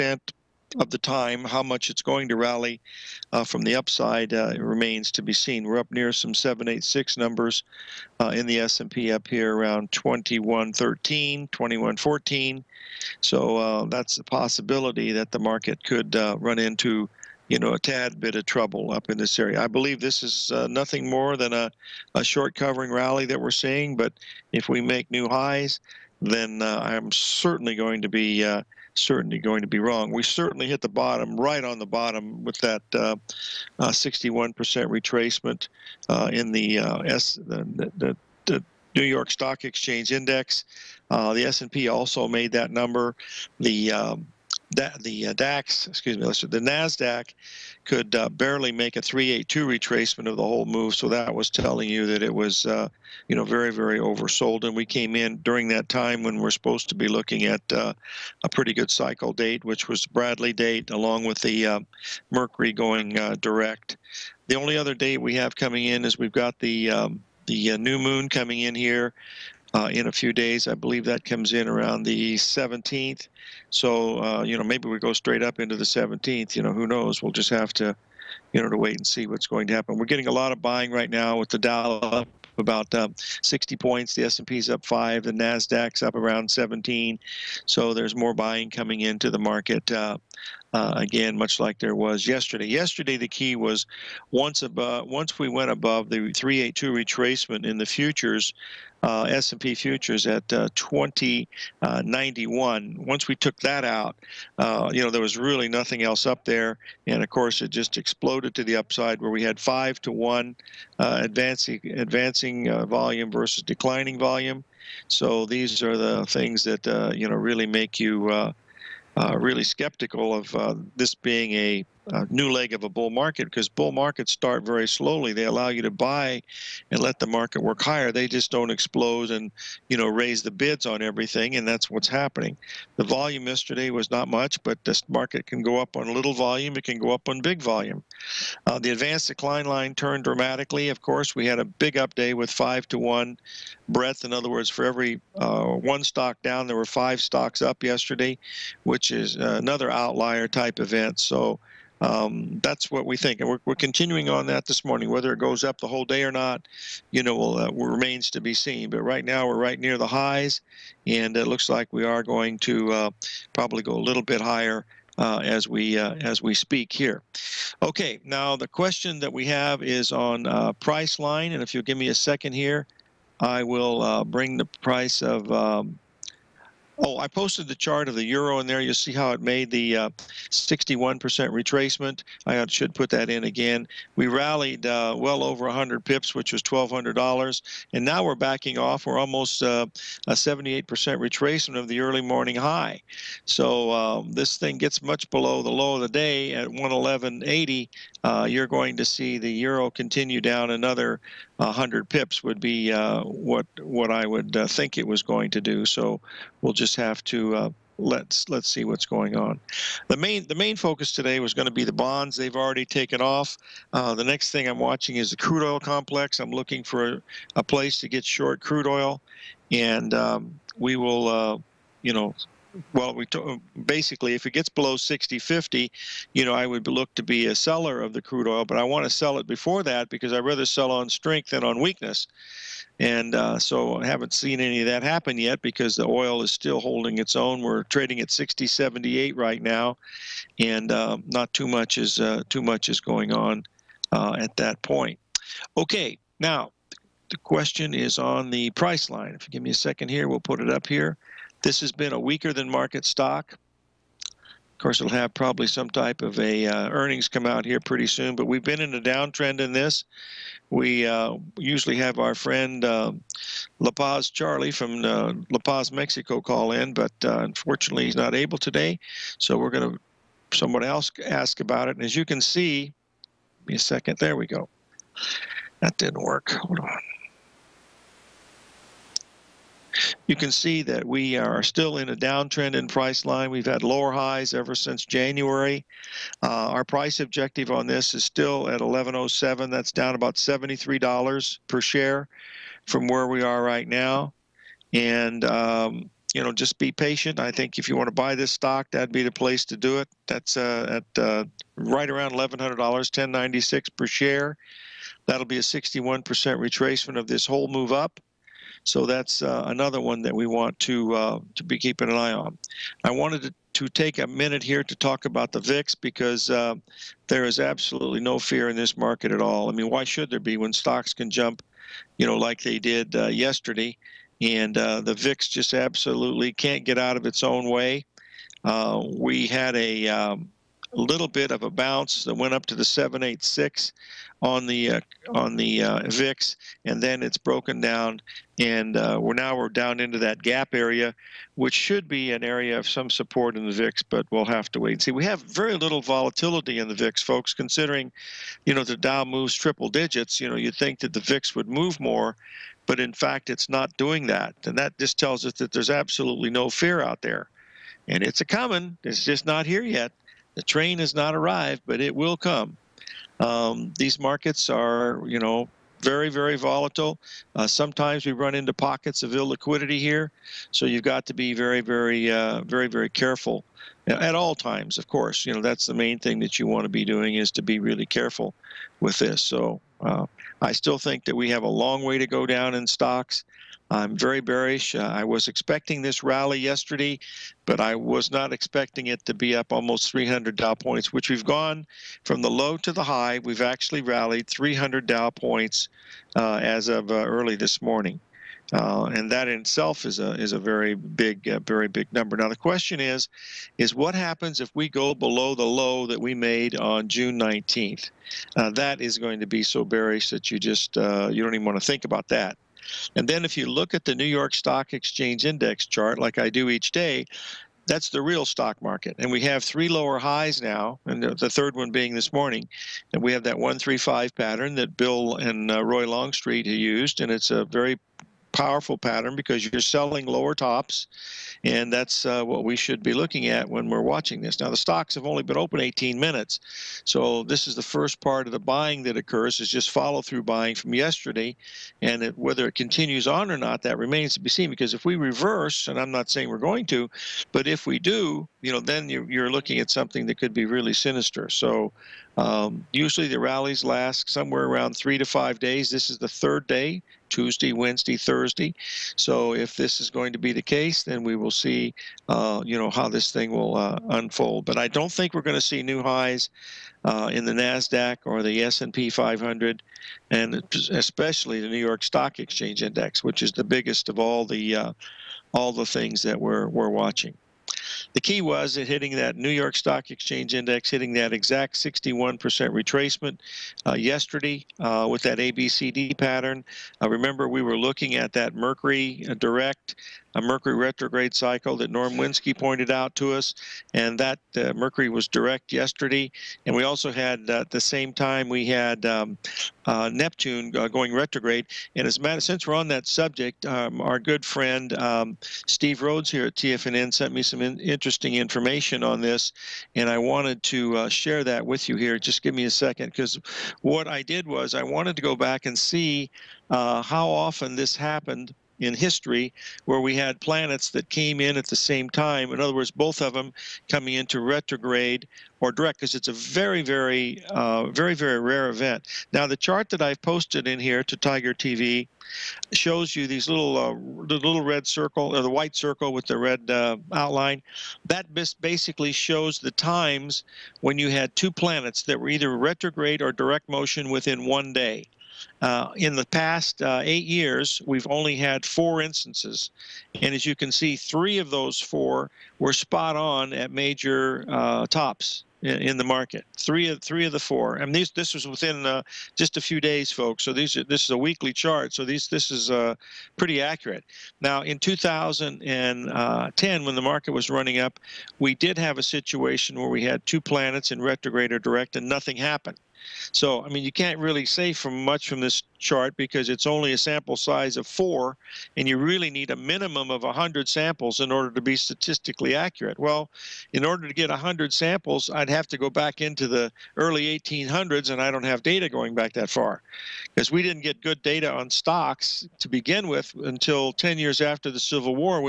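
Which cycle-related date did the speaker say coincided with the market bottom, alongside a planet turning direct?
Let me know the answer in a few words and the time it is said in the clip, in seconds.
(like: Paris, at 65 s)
Bradley date, at 60 s.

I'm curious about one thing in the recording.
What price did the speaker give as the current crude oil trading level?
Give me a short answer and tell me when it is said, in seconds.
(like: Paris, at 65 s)
60.78, at 238 s.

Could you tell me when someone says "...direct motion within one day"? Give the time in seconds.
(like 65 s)
543 s.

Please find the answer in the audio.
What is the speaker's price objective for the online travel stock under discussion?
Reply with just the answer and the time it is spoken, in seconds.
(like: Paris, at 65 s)
1107, at 288 s.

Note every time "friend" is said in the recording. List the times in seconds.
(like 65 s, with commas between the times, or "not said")
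262 s, 504 s.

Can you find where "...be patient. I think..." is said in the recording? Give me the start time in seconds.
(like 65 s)
296 s.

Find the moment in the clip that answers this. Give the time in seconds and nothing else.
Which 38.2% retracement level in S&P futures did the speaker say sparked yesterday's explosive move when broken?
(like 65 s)
100 s.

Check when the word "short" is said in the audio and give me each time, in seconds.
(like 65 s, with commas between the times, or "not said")
22 s, 218 s.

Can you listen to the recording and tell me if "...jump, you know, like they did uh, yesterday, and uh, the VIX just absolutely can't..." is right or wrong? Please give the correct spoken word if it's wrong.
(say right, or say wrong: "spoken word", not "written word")
right.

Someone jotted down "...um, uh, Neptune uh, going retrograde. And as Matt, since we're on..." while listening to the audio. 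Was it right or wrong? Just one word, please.
right.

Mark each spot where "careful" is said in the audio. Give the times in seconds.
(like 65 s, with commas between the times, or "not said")
373 s, 378 s.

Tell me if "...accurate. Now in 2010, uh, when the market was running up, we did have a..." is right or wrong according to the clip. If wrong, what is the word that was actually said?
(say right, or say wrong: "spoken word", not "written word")
right.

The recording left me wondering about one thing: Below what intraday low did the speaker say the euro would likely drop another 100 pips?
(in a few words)
111.80.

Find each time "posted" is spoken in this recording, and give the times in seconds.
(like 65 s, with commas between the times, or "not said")
177 s, 530 s.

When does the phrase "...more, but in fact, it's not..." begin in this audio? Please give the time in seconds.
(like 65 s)
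351 s.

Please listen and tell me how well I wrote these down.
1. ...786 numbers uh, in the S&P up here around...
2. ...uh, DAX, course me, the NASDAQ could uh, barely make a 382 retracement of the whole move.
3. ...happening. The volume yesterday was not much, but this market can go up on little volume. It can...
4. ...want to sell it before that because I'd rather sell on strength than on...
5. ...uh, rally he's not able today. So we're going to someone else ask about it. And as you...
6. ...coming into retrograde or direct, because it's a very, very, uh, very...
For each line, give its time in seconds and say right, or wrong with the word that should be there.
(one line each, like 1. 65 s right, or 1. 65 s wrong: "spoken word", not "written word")
1. 6 s right
2. 45 s wrong: "excuse", not "course"
3. 132 s right
4. 228 s right
5. 267 s wrong: "unfortunately", not "rally"
6. 523 s right.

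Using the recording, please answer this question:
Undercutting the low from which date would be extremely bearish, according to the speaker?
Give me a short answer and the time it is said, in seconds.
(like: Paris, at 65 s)
June 19th, at 407 s.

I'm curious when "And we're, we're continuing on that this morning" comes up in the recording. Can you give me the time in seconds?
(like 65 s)
153 s.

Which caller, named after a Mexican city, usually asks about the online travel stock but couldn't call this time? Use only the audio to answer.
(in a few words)
La Paz Charlie.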